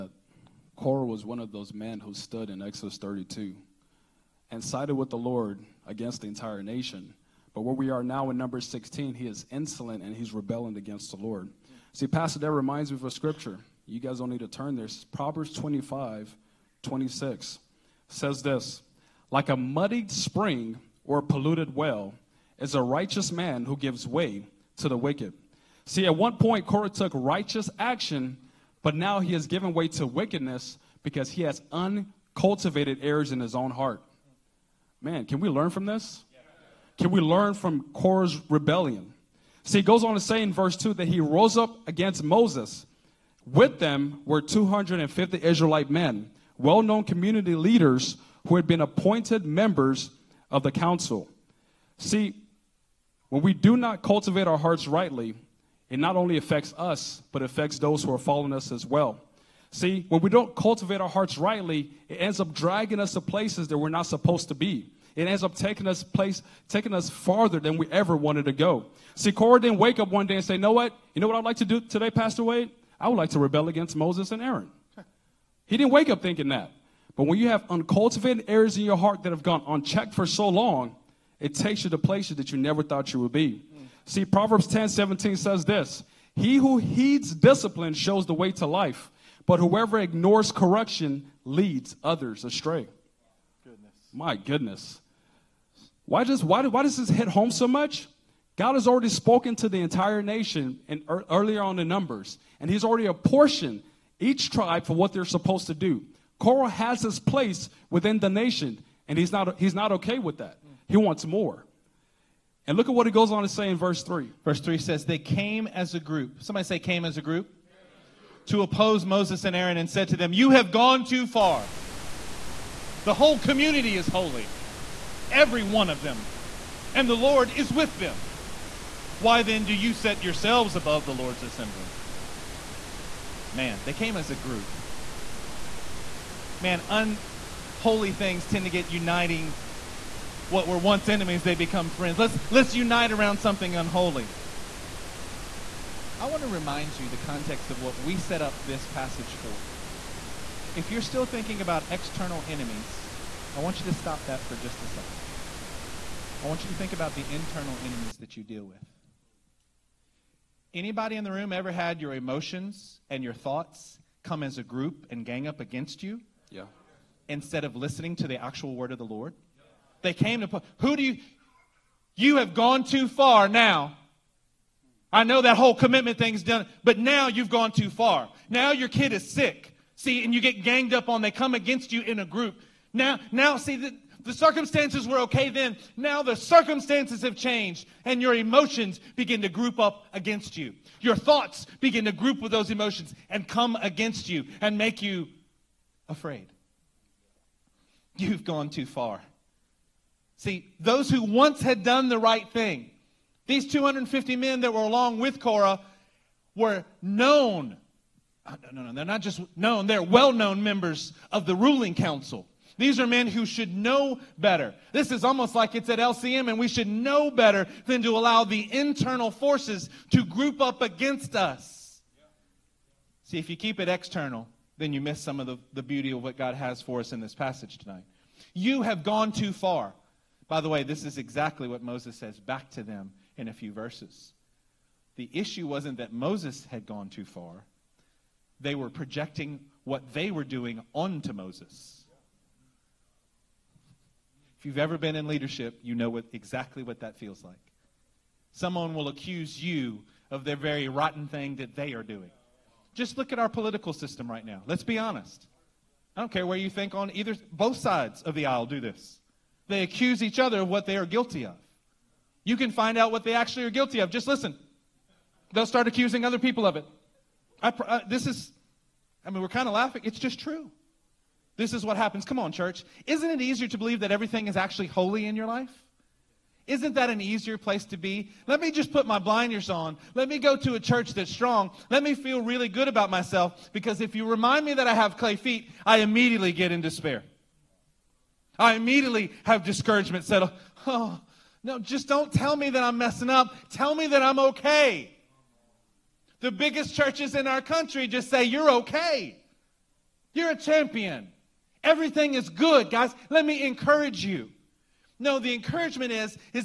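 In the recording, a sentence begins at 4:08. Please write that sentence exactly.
Someone will accuse you of the very rotten thing that they are doing.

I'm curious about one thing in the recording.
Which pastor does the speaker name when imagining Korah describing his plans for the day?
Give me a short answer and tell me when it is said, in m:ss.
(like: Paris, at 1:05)
Pastor Wade, at 1:12.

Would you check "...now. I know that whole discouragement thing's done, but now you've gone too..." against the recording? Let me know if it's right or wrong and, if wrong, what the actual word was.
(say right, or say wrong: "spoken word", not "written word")
wrong: "commitment", not "discouragement".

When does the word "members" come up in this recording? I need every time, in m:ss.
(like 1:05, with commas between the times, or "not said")
0:49, 3:30.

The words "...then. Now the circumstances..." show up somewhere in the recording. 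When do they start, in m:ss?
3:05.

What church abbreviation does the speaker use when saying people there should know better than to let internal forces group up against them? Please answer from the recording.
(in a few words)
LCM.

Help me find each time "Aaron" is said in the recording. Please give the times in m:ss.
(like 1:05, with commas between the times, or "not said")
1:14, 1:59.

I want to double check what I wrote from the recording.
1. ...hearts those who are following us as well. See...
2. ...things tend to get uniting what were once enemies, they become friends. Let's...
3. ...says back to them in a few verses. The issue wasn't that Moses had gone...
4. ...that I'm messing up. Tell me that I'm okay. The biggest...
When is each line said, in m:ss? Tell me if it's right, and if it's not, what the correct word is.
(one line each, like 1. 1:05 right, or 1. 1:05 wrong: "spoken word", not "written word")
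1. 0:57 wrong: "affects", not "hearts"
2. 2:18 right
3. 3:52 right
4. 4:52 right.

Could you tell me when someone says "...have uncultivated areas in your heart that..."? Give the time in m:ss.
1:17.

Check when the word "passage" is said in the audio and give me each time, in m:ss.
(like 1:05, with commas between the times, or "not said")
2:28, 3:47.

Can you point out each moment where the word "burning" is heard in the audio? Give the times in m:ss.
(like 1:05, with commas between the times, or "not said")
not said.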